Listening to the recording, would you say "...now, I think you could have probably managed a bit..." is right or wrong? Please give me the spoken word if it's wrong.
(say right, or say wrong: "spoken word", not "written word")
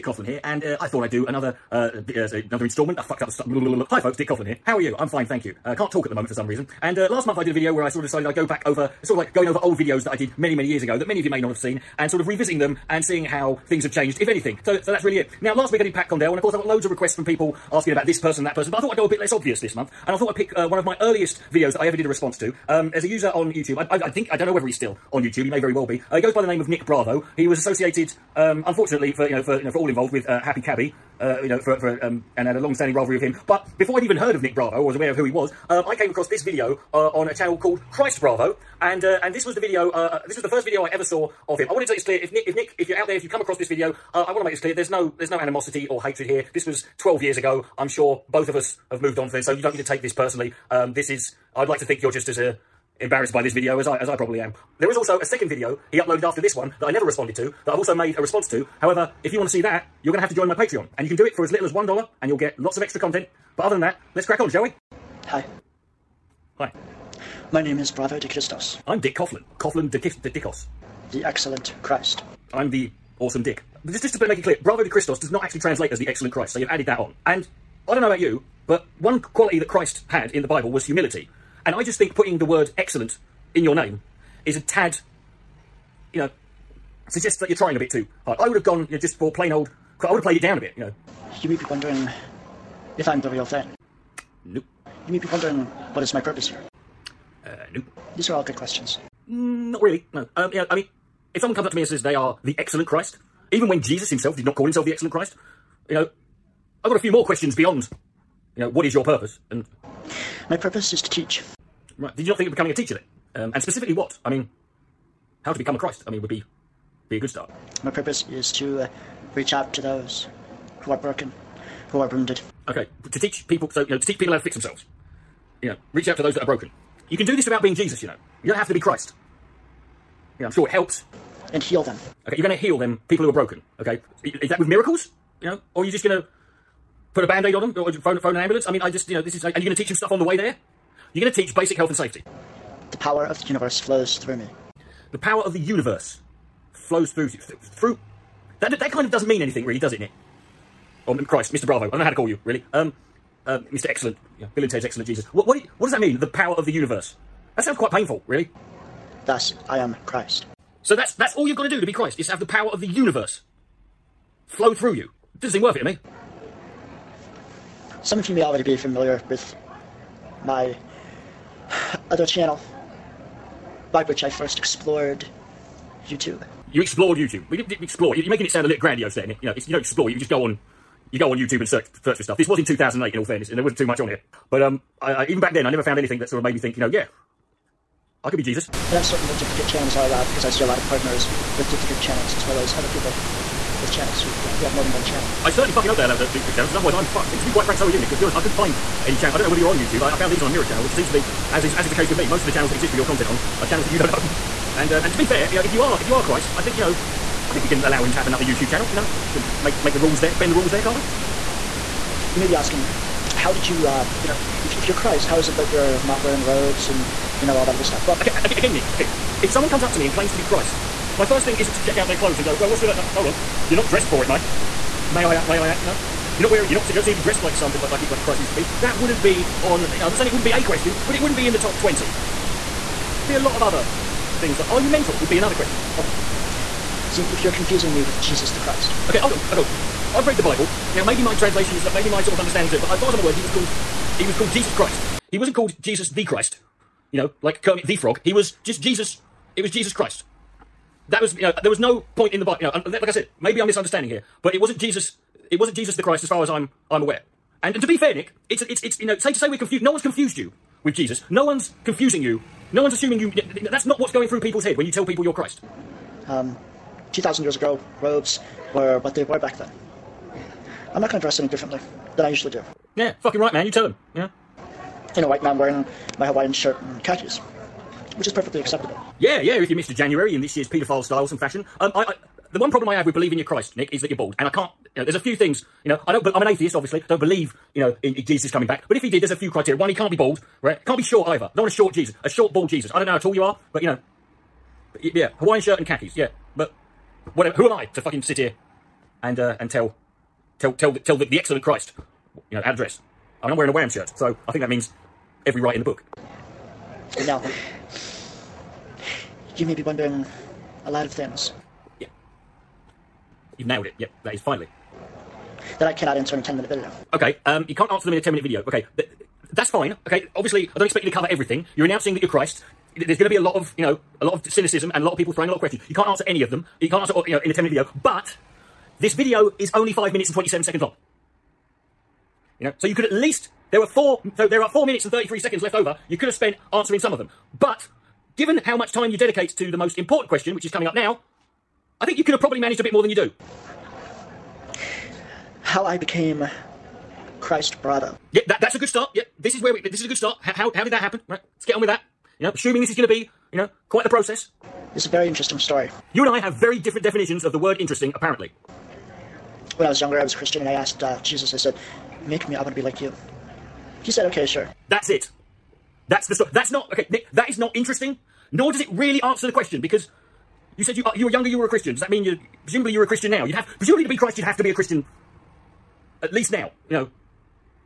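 right.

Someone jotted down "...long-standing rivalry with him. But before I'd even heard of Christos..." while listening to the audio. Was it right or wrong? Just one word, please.
wrong.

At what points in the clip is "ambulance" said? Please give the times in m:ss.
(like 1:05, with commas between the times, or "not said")
2:18.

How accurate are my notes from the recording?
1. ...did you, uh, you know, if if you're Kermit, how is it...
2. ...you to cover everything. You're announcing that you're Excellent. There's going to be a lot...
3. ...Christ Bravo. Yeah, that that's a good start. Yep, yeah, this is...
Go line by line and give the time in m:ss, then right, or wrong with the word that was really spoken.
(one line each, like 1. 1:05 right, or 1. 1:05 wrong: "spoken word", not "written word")
1. 3:33 wrong: "Christ", not "Kermit"
2. 5:21 wrong: "Christ", not "Excellent"
3. 5:47 right.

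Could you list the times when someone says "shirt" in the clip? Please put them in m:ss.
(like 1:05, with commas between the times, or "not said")
4:36, 4:55, 5:03.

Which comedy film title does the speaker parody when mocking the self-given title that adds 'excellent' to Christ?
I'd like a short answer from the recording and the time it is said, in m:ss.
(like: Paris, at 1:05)
Bill and Ted's Excellent Jesus, at 2:34.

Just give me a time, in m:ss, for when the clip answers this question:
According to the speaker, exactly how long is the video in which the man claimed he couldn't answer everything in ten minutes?
5:29.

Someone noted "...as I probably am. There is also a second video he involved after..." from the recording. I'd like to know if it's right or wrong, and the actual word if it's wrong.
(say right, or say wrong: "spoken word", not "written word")
wrong: "uploaded", not "involved".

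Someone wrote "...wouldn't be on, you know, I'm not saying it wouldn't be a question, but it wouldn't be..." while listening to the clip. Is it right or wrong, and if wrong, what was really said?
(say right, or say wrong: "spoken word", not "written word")
right.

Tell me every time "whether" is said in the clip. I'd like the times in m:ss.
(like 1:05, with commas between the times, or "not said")
0:24, 3:19.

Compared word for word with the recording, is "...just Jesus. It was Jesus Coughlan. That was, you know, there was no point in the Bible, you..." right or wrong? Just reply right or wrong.
wrong.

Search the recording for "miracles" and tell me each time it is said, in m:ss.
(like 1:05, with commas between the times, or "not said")
2:14.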